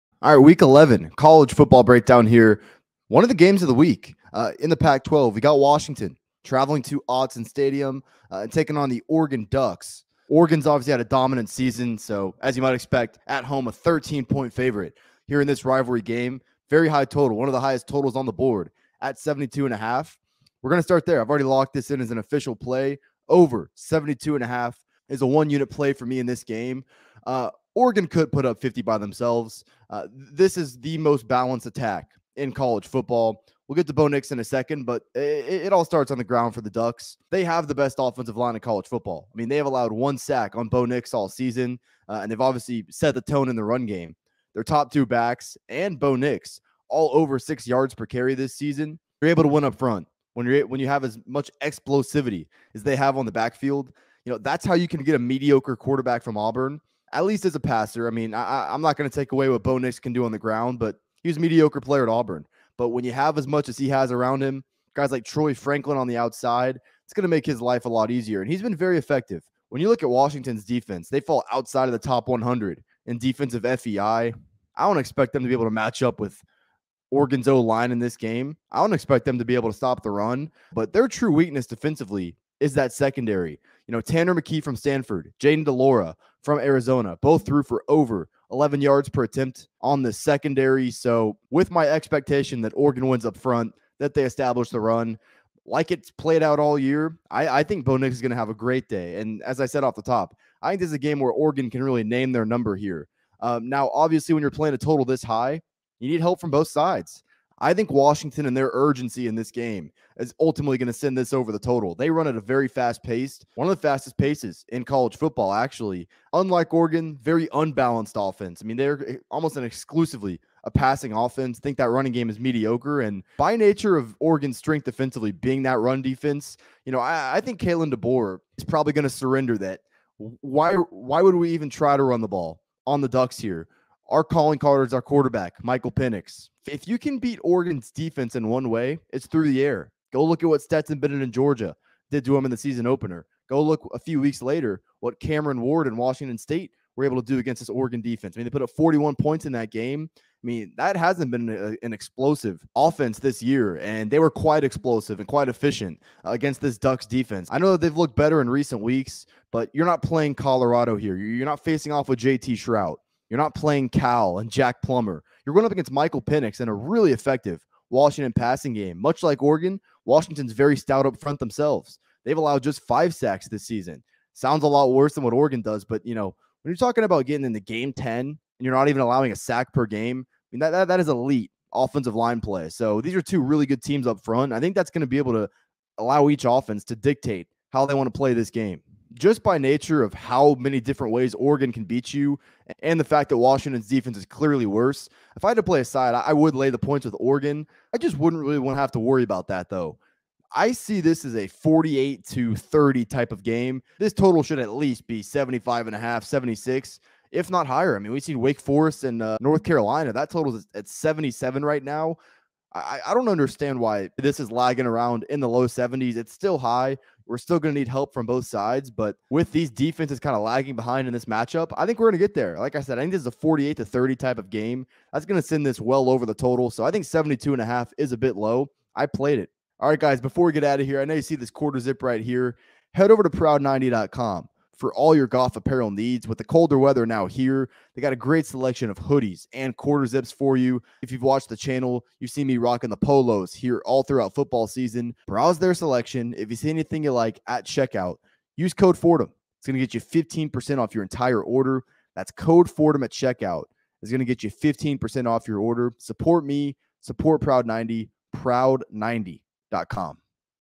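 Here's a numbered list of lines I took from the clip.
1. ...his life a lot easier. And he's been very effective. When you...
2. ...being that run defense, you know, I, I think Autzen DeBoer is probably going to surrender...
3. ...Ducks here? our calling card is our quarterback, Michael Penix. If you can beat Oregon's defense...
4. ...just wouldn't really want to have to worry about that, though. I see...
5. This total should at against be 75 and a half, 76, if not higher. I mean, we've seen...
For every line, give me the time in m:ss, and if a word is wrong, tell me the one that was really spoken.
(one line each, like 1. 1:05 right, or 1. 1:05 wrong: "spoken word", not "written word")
1. 1:07 right
2. 2:05 wrong: "Kalen", not "Autzen"
3. 2:13 right
4. 3:17 right
5. 3:23 wrong: "least", not "against".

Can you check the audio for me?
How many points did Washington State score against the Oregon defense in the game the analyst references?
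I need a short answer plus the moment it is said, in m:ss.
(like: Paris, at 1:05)
41, at 2:28.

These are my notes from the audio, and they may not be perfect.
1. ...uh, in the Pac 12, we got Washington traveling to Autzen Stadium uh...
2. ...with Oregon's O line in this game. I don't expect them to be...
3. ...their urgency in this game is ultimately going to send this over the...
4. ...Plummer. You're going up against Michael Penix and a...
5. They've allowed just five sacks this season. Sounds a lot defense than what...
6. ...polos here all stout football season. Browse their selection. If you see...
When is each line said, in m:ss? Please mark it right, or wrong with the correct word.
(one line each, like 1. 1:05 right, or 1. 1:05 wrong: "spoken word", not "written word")
1. 0:04 right
2. 1:16 right
3. 1:48 right
4. 2:44 right
5. 2:52 wrong: "worse", not "defense"
6. 4:02 wrong: "throughout", not "stout".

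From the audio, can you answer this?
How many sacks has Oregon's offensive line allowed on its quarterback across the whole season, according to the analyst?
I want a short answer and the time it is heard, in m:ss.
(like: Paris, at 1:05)
1, at 0:39.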